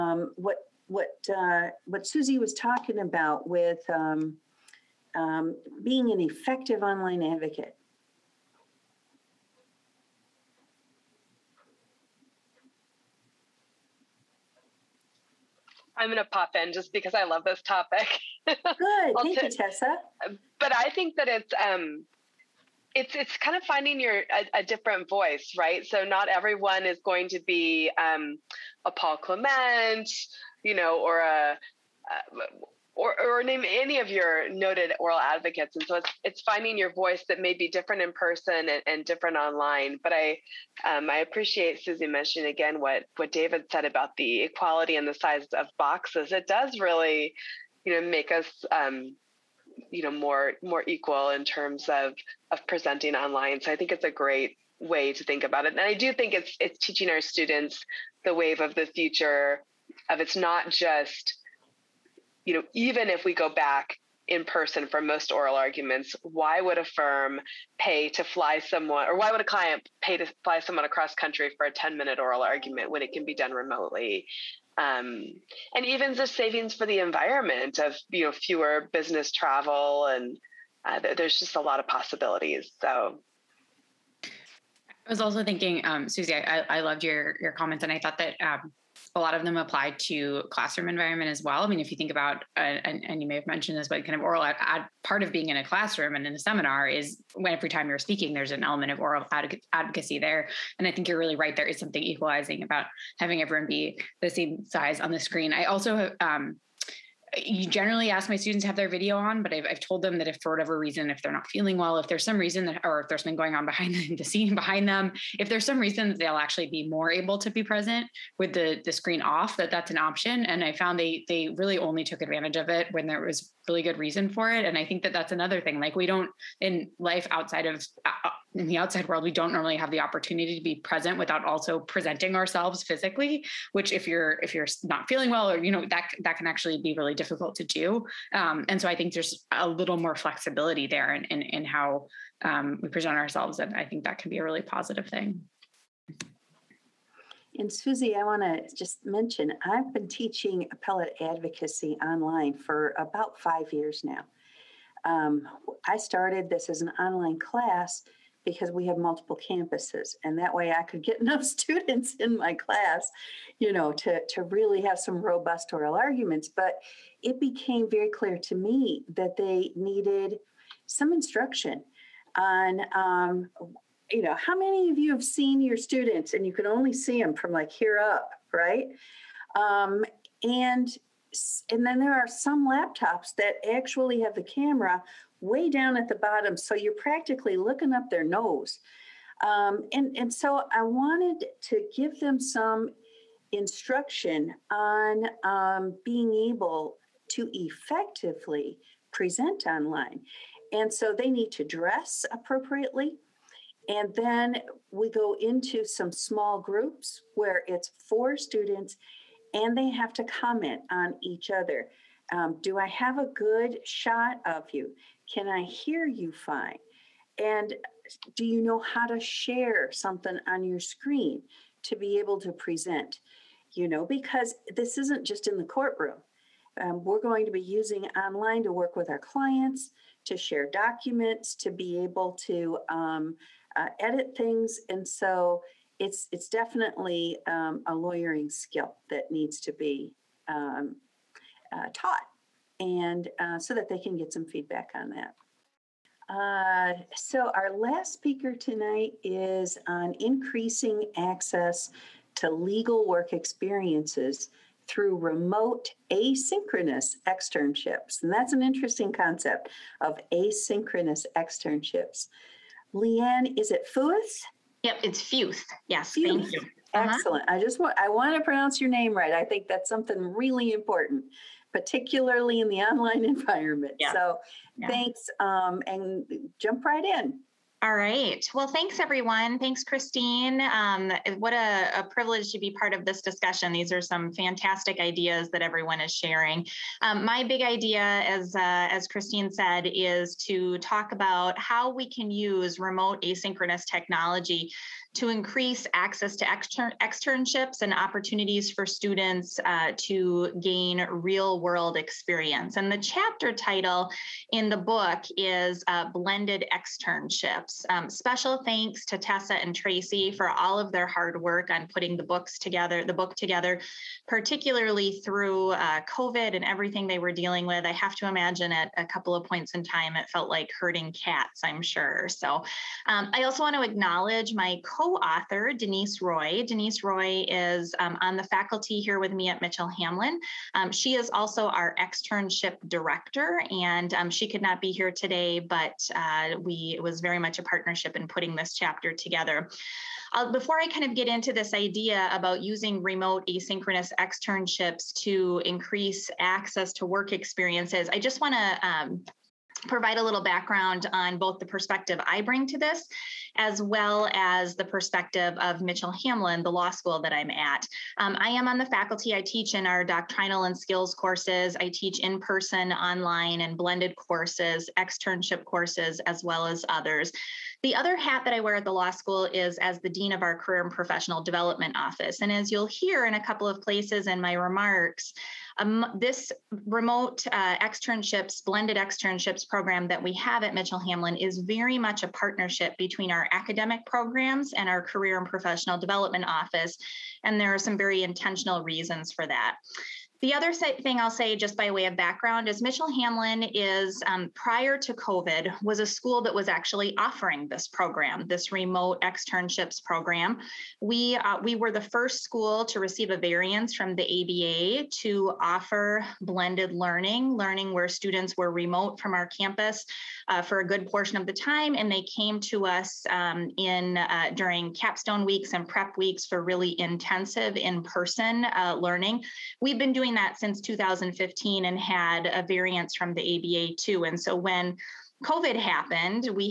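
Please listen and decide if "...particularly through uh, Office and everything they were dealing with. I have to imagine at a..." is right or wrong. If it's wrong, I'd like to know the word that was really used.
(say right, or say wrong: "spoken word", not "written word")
wrong: "COVID", not "Office".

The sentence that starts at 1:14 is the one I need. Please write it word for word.
Um, and even the savings for the environment of you know fewer business travel and uh, there's just a lot of possibilities.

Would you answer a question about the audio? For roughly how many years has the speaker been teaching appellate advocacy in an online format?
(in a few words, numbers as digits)
5 years.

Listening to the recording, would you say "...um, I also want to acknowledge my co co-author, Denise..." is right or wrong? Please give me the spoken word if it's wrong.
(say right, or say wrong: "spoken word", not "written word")
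right.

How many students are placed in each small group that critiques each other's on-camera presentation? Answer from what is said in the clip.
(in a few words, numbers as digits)
4.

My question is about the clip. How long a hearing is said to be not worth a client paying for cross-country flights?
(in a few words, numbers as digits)
10 minute.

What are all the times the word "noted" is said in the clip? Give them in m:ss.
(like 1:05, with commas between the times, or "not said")
0:34.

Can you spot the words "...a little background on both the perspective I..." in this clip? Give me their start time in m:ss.
5:50.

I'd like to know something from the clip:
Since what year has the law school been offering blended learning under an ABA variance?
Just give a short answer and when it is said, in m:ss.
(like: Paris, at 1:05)
2015, at 7:00.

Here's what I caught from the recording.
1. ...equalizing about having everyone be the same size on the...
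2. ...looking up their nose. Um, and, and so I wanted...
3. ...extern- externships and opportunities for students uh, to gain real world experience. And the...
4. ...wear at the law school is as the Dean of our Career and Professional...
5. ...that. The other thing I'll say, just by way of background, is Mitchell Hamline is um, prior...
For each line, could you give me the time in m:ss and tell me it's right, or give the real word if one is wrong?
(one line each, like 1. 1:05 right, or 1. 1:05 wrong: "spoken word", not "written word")
1. 1:42 right
2. 3:07 right
3. 4:56 right
4. 6:08 right
5. 6:29 right.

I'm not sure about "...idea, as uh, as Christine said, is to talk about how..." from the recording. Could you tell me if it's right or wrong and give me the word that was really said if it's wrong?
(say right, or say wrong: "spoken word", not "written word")
right.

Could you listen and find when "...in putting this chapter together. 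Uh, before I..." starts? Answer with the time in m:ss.
5:38.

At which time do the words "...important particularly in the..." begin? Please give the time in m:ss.
4:30.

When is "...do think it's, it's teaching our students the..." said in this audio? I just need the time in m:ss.
0:55.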